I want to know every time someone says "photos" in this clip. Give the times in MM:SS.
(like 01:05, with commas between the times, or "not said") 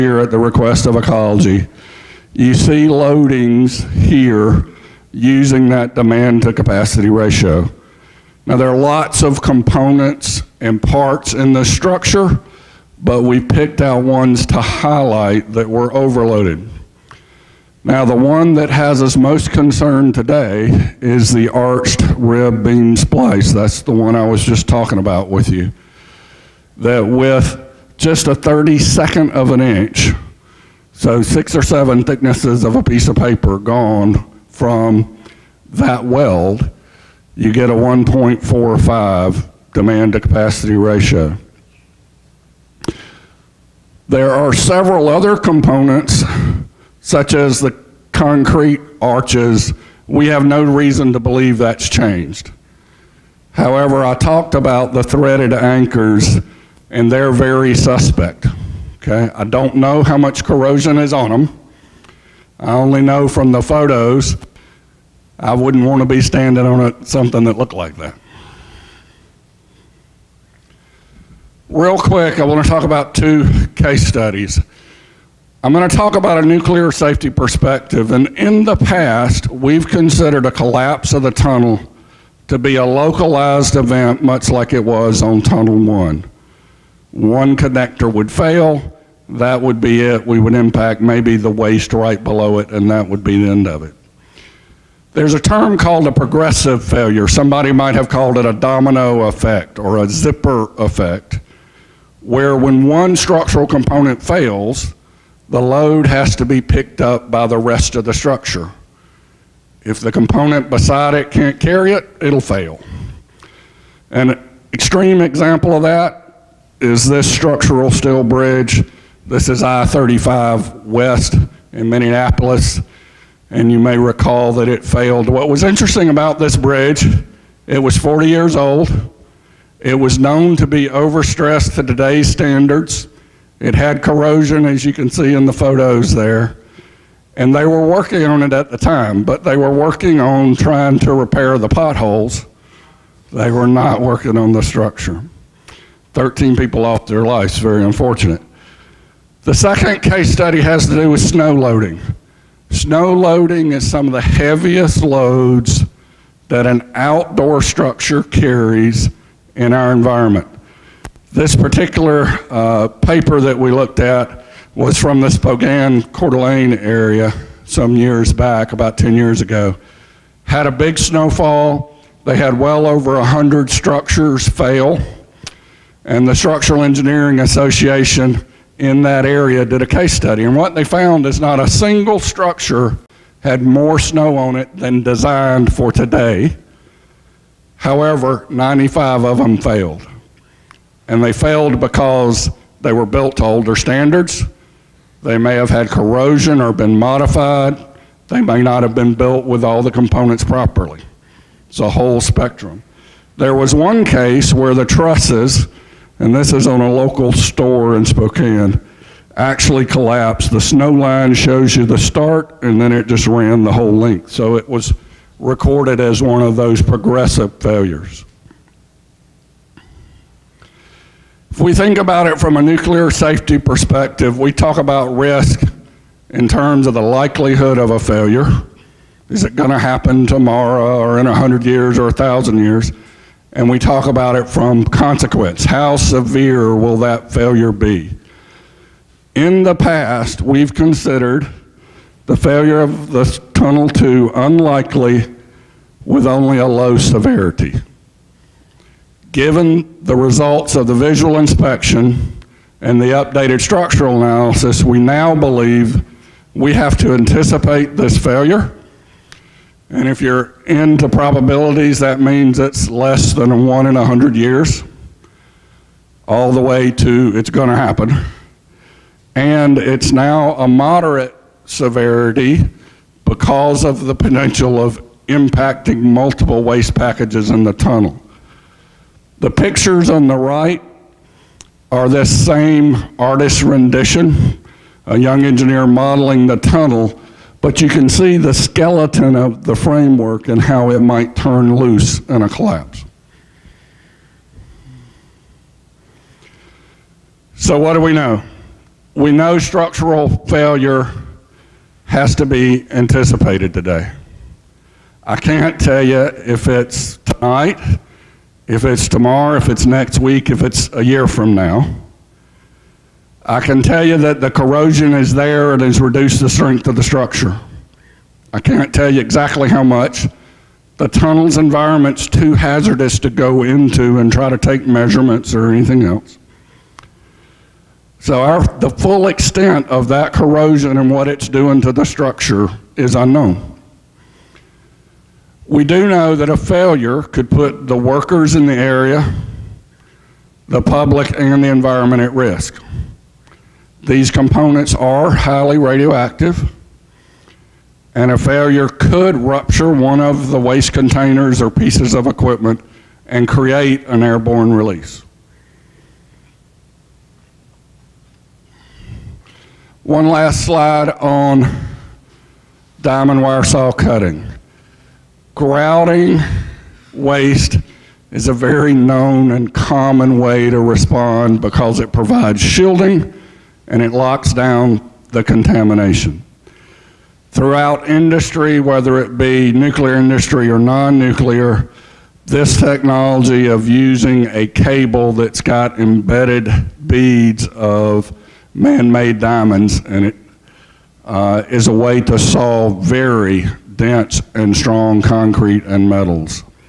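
01:03, 02:15.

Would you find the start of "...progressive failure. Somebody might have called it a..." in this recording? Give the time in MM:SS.
01:36.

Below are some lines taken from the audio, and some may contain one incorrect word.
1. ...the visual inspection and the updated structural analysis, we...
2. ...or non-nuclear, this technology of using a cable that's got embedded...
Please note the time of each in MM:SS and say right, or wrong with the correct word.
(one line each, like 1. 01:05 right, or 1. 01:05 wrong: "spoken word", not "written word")
1. 04:10 right
2. 06:20 right.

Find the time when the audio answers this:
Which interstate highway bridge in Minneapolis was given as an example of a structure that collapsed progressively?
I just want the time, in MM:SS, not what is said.
01:59.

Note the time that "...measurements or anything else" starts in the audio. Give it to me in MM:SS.
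05:24.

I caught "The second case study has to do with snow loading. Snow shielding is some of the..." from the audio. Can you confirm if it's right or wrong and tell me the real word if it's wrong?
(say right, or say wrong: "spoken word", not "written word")
wrong: "loading", not "shielding".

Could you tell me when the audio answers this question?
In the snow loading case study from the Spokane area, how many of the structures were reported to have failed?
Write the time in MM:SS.
03:08.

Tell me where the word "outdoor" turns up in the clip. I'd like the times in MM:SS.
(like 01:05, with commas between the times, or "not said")
02:36.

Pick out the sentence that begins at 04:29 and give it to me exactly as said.
And it's now a moderate severity because of the potential of impacting multiple waste packages in the tunnel.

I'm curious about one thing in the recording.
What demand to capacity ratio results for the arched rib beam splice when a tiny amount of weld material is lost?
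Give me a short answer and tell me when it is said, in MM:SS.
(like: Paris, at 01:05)
1.45, at 00:37.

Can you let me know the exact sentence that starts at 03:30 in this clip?
The snow line shows you the start, and then it just ran the whole length.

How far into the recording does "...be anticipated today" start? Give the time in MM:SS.
05:02.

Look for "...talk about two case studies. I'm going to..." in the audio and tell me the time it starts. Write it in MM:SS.
01:12.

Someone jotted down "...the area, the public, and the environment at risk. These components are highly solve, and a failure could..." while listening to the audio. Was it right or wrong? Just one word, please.
wrong.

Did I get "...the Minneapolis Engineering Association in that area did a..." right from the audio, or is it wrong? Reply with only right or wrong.
wrong.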